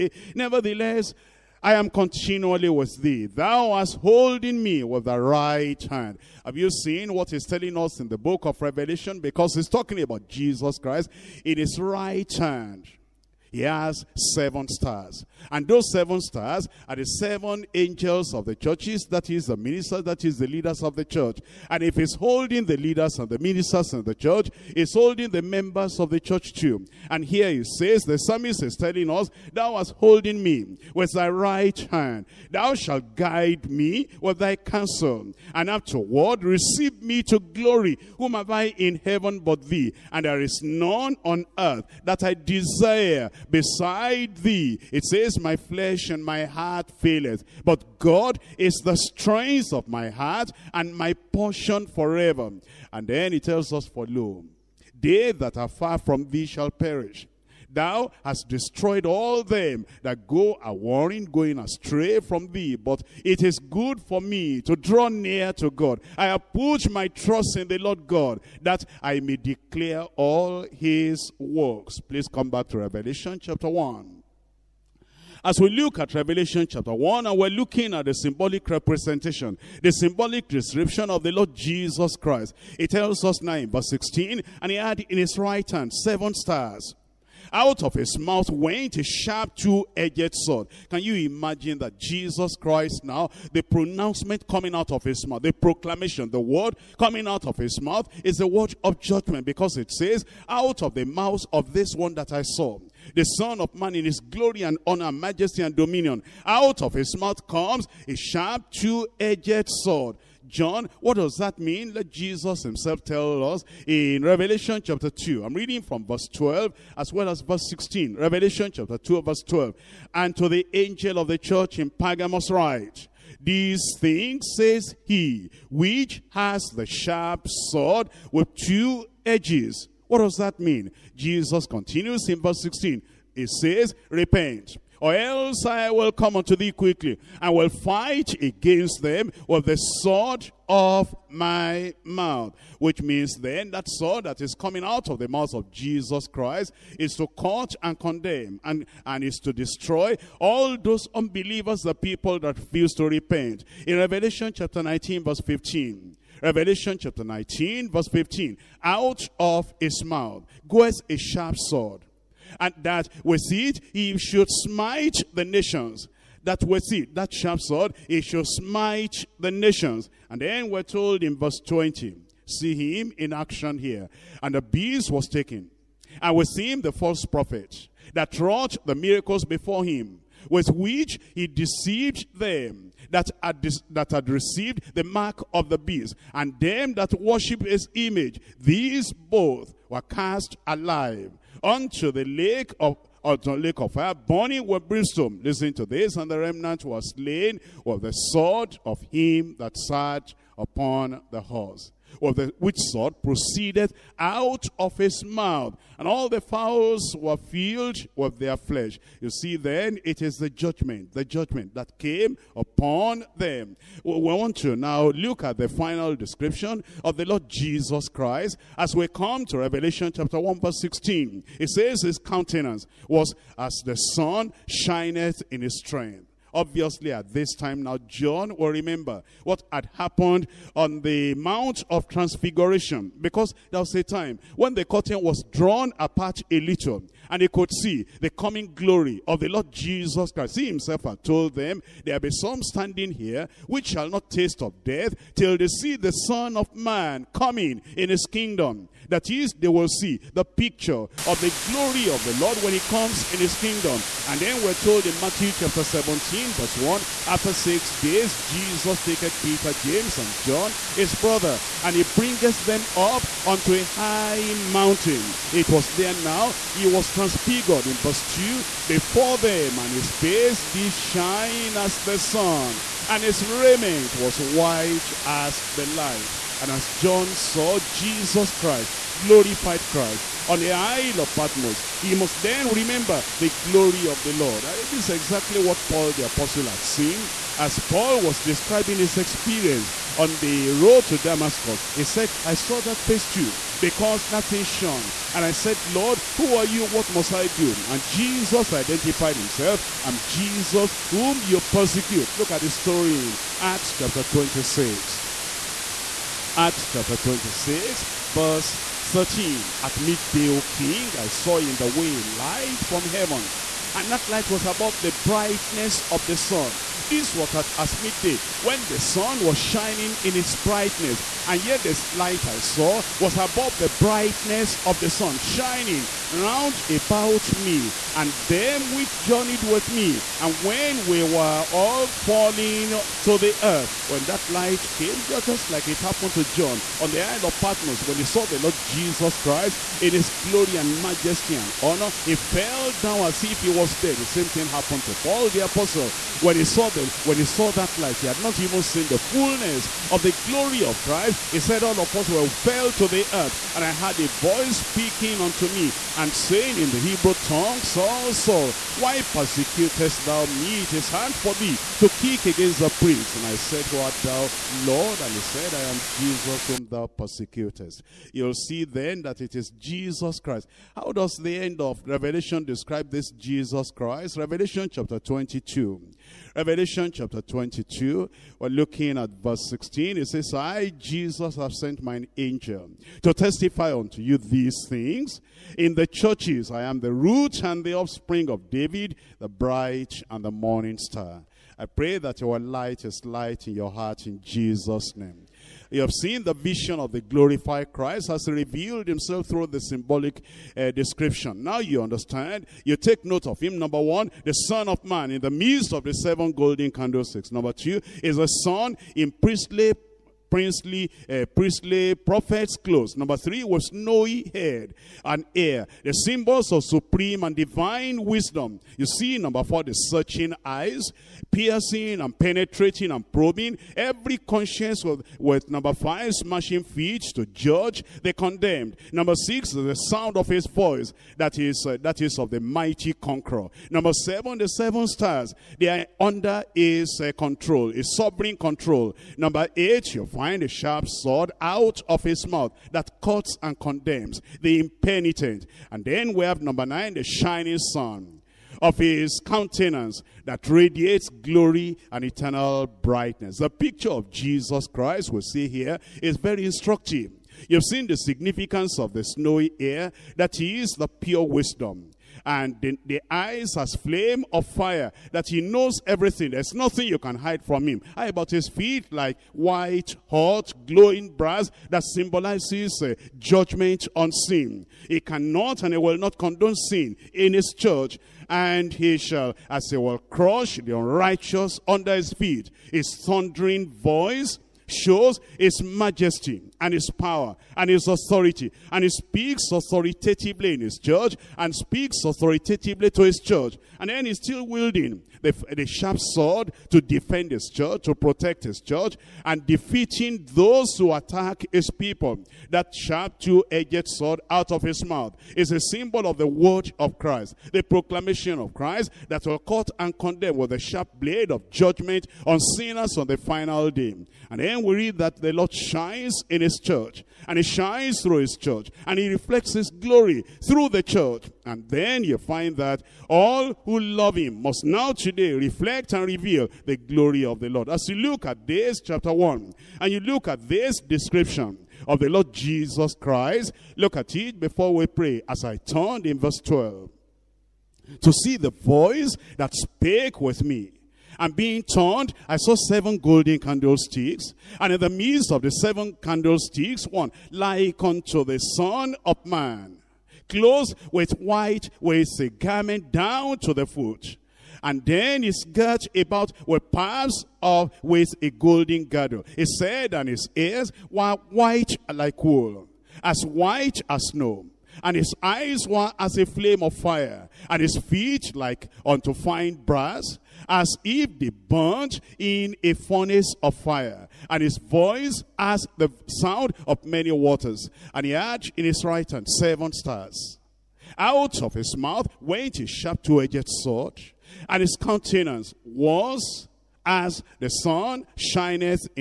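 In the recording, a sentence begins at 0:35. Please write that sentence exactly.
And afterward, receive me to glory.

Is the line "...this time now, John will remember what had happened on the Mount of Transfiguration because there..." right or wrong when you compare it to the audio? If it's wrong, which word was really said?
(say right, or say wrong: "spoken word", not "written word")
right.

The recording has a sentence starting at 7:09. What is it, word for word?
Number six, the sound of his voice, that is, uh, that is of the mighty conqueror.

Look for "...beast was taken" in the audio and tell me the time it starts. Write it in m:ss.
2:54.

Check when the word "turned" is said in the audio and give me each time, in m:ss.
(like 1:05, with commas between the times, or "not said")
8:55, 9:01.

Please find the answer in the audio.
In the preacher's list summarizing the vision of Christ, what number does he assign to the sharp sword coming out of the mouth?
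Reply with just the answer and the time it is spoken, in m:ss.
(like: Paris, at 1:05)
8, at 7:19.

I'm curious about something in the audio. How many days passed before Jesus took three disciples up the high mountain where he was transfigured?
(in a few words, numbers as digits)
6.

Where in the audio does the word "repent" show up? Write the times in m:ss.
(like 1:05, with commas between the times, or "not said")
2:14, 2:33.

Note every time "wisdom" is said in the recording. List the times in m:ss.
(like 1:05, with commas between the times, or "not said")
6:58, 7:41.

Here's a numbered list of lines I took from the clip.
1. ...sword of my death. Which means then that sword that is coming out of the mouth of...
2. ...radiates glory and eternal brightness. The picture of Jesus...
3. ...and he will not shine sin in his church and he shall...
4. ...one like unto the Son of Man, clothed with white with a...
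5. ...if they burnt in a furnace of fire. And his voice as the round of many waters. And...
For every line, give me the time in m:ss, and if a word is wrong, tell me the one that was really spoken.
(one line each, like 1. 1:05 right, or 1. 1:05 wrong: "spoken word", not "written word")
1. 2:19 wrong: "mouth", not "death"
2. 7:30 right
3. 7:55 wrong: "condone", not "shine"
4. 9:07 right
5. 9:31 wrong: "sound", not "round".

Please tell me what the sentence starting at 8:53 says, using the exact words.
Look at it before we pray.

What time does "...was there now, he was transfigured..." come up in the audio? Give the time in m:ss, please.
4:25.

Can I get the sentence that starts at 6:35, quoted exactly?
You have seen the vision of the glorified Christ has revealed himself through the symbolic uh, description.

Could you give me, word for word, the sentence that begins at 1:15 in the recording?
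As we look at Revelation chapter 1, and we're looking at the symbolic representation, the symbolic description of the Lord Jesus Christ.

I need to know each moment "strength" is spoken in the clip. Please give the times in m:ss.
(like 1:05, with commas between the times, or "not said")
0:48, 3:45.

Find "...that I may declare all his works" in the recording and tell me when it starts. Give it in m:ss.
1:08.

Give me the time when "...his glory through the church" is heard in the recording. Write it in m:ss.
8:39.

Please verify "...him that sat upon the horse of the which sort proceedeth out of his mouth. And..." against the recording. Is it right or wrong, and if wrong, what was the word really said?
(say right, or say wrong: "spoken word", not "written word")
right.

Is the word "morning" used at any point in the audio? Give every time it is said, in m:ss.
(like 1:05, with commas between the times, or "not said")
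6:30.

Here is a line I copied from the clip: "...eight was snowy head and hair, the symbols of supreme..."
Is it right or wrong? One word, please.
wrong.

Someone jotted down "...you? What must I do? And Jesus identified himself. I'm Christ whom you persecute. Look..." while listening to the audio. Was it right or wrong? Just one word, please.
wrong.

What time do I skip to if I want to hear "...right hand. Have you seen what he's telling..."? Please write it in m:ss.
0:05.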